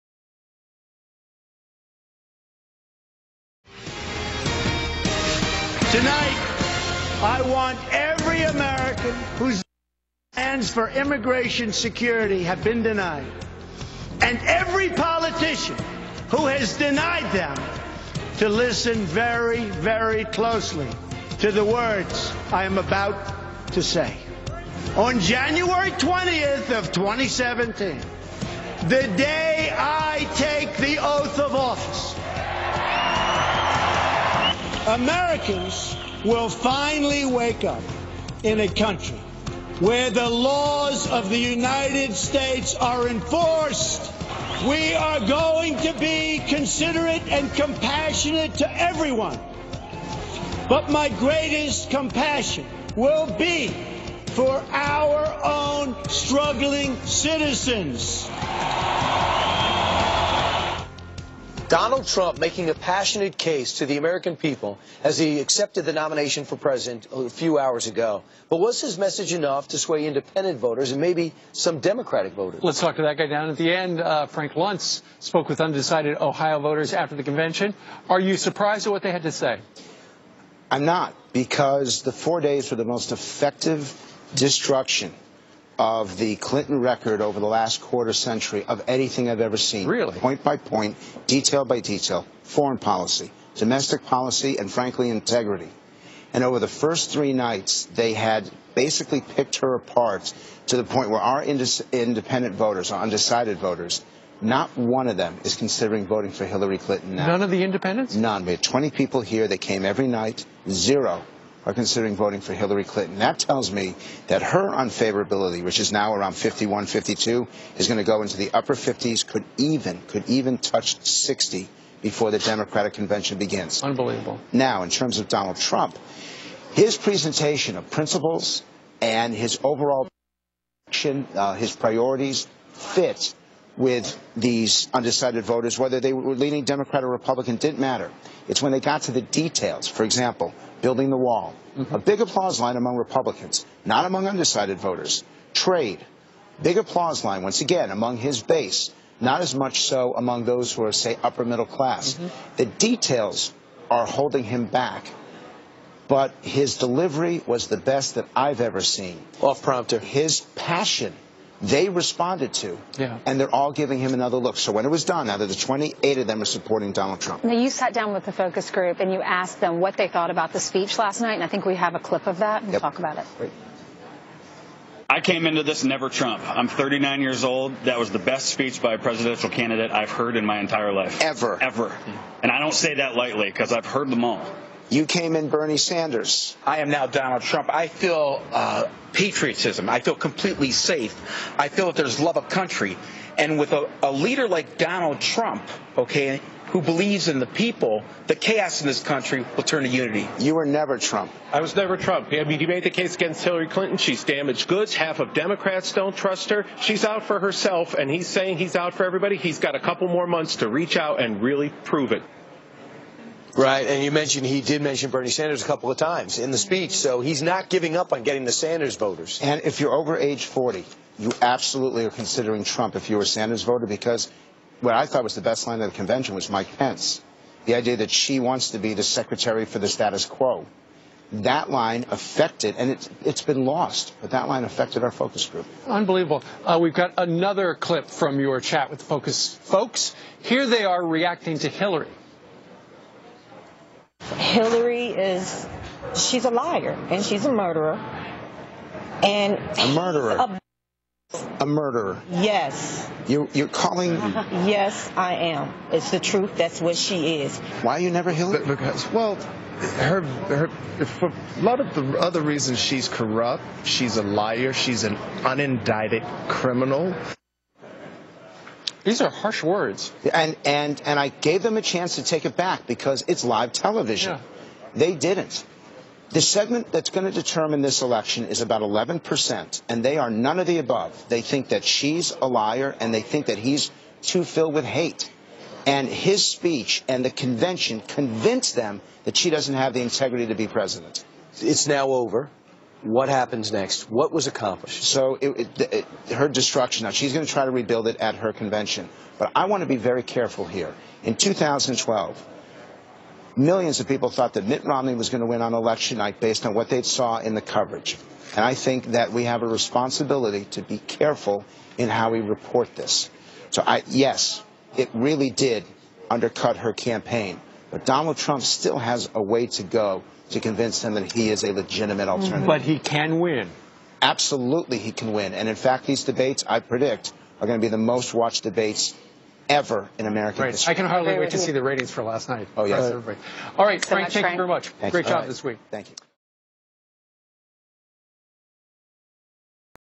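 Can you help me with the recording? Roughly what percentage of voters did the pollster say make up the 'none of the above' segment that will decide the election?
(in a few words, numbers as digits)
11%.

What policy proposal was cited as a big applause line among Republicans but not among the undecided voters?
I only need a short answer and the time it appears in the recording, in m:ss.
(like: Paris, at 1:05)
building the wall, at 2:20.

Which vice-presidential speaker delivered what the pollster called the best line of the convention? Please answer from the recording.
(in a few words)
Mike Pence.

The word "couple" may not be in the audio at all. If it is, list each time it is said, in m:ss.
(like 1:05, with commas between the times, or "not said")
3:29, 3:35.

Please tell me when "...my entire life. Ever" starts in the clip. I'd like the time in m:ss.
3:00.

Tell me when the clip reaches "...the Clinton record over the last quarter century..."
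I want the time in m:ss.
1:26.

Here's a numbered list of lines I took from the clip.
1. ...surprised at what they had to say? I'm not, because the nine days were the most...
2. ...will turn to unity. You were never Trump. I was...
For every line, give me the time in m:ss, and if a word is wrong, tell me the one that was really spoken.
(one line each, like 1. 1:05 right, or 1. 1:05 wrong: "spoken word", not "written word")
1. 1:18 wrong: "four", not "nine"
2. 3:19 right.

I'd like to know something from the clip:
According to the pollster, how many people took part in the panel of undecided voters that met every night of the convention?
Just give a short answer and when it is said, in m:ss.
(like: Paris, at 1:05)
20, at 1:48.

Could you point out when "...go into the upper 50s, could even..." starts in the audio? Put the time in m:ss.
1:58.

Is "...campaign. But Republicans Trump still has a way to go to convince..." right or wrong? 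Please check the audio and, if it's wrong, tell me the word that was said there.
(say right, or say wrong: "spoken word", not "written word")
wrong: "Donald", not "Republicans".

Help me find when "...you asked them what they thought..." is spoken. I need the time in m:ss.
2:49.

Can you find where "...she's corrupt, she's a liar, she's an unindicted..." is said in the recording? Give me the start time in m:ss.
4:22.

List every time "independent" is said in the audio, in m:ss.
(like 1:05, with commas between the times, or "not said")
1:10, 1:41, 1:47.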